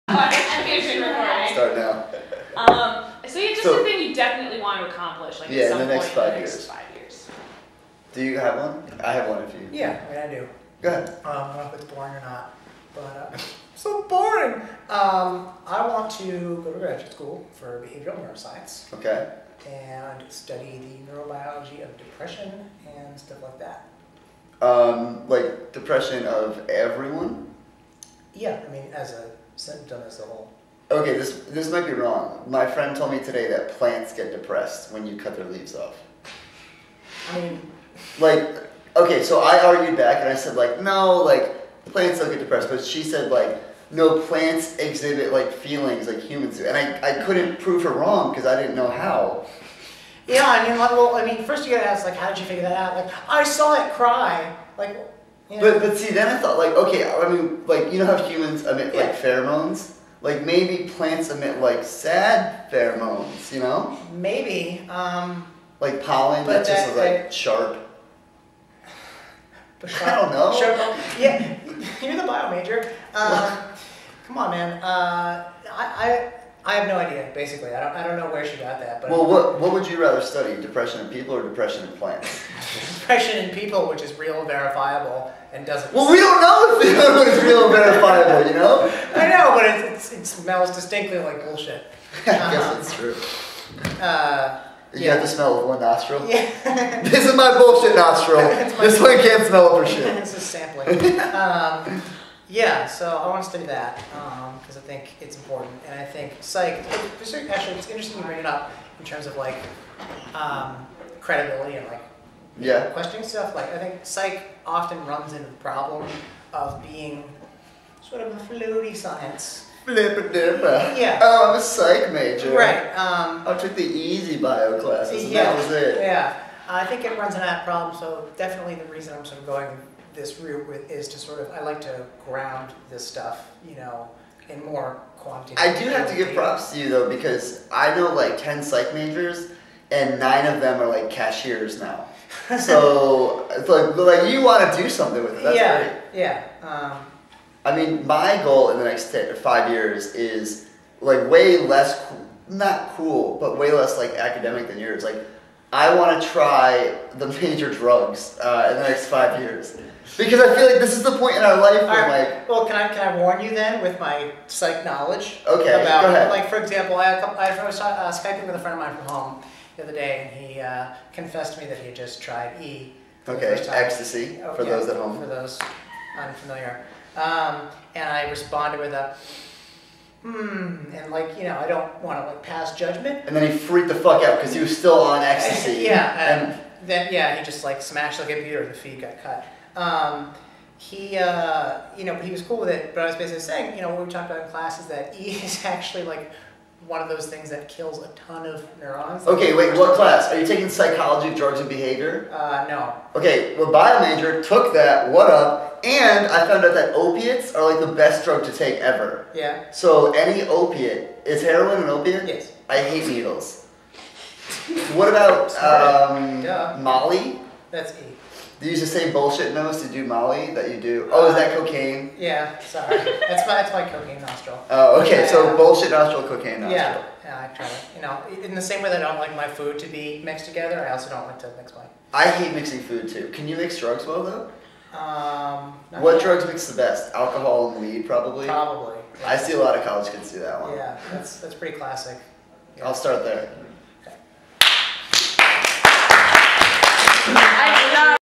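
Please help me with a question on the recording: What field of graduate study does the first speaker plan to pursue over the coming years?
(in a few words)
behavioral neuroscience.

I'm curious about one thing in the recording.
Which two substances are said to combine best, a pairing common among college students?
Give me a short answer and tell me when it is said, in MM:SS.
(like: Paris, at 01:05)
alcohol and weed, at 03:57.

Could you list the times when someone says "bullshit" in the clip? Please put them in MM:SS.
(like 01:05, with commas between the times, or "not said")
01:31, 01:37, 03:39, 03:45.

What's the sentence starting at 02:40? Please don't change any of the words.
Because I feel like this is the point in our life where, right.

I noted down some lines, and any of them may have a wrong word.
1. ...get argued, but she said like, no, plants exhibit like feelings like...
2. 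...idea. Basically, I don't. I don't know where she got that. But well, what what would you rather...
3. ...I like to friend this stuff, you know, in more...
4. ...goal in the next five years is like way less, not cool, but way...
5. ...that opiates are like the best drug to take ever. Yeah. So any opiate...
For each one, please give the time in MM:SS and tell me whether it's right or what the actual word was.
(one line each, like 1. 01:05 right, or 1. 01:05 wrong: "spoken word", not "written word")
1. 00:42 wrong: "depressed", not "argued"
2. 01:16 right
3. 02:11 wrong: "ground", not "friend"
4. 02:28 right
5. 03:26 right.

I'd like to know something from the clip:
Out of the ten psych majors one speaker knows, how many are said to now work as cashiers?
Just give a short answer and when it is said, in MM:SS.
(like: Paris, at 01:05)
9, at 02:20.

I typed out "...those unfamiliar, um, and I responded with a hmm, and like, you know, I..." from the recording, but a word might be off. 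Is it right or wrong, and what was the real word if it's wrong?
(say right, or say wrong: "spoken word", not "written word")
right.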